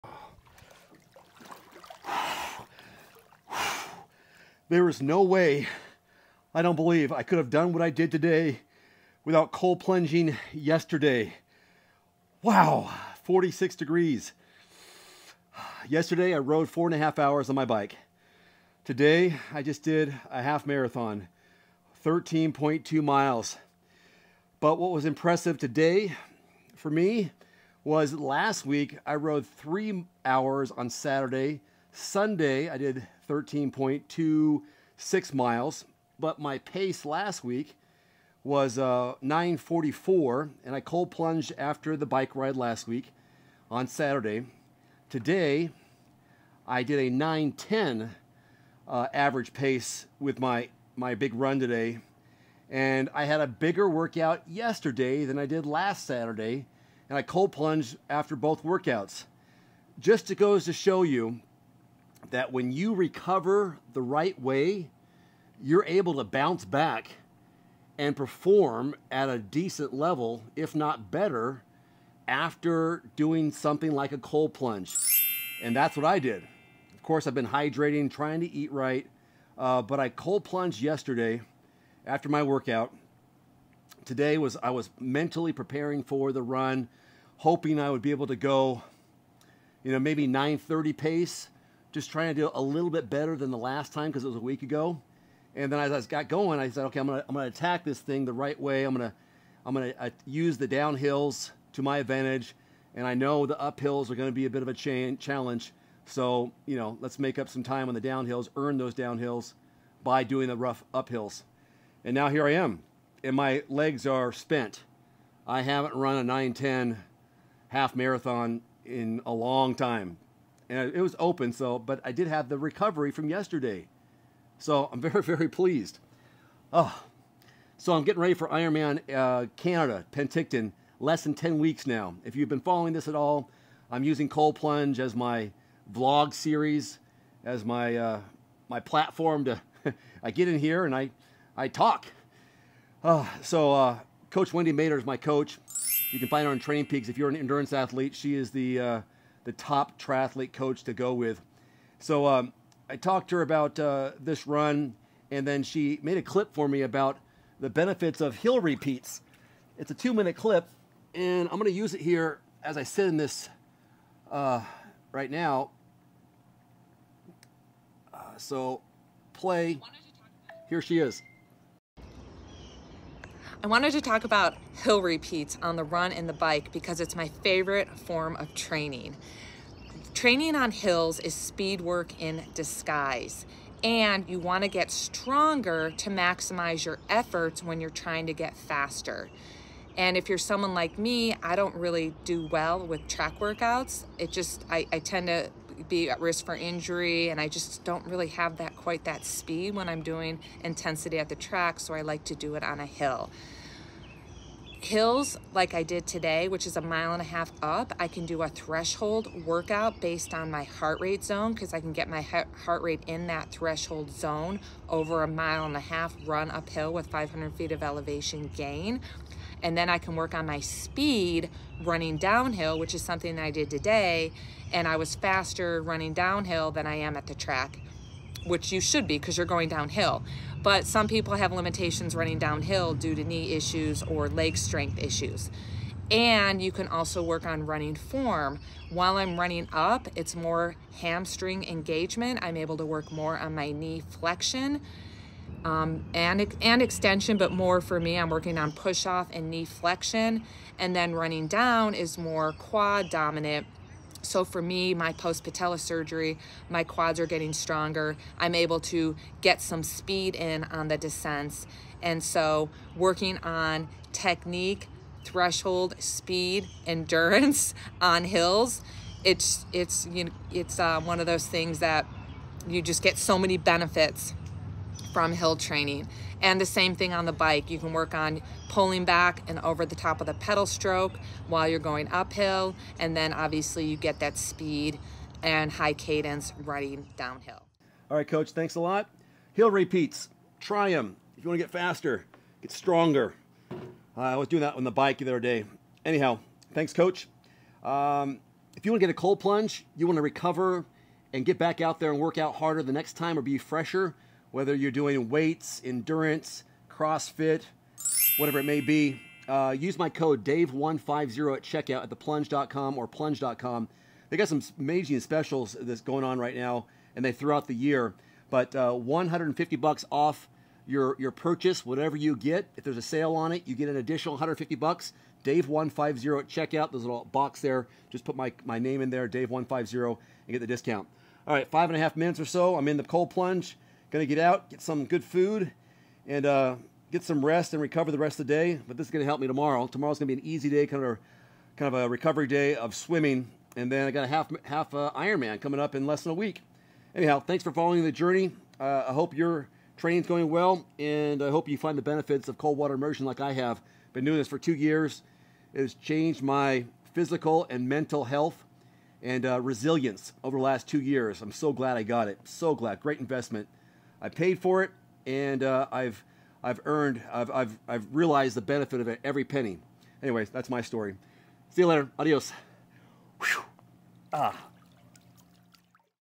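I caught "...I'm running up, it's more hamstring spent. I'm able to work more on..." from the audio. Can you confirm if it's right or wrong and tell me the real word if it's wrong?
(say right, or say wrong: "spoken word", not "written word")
wrong: "engagement", not "spent".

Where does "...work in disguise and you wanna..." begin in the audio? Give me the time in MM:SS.
03:01.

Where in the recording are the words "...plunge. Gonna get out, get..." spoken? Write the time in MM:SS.
05:33.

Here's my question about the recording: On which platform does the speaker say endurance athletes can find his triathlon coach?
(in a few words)
Training Peaks.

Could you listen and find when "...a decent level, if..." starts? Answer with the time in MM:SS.
01:09.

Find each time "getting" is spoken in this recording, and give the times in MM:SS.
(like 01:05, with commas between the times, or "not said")
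02:08, 04:17.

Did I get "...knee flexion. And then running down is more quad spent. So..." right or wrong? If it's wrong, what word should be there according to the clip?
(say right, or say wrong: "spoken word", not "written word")
wrong: "dominant", not "spent".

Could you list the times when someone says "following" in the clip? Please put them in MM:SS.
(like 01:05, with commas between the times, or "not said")
02:12, 05:47.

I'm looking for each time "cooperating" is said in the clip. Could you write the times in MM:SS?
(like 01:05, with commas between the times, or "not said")
not said.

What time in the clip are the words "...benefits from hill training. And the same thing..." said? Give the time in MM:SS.
04:33.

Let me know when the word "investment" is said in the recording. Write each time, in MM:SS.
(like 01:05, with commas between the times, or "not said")
06:03.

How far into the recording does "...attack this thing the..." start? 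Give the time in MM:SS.
01:37.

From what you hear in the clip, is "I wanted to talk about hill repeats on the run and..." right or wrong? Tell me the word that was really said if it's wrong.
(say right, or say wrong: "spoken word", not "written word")
right.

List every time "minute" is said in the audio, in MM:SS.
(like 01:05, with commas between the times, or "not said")
02:40, 05:32.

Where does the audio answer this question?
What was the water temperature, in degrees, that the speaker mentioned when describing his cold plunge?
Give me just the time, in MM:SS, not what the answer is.
00:13.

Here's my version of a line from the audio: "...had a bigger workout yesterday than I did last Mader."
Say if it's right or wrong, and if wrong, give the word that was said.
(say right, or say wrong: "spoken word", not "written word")
wrong: "Saturday", not "Mader".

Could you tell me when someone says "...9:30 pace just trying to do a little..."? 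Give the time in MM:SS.
01:30.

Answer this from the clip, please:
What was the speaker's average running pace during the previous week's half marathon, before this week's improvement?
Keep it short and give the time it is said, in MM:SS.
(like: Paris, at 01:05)
9:44, at 00:39.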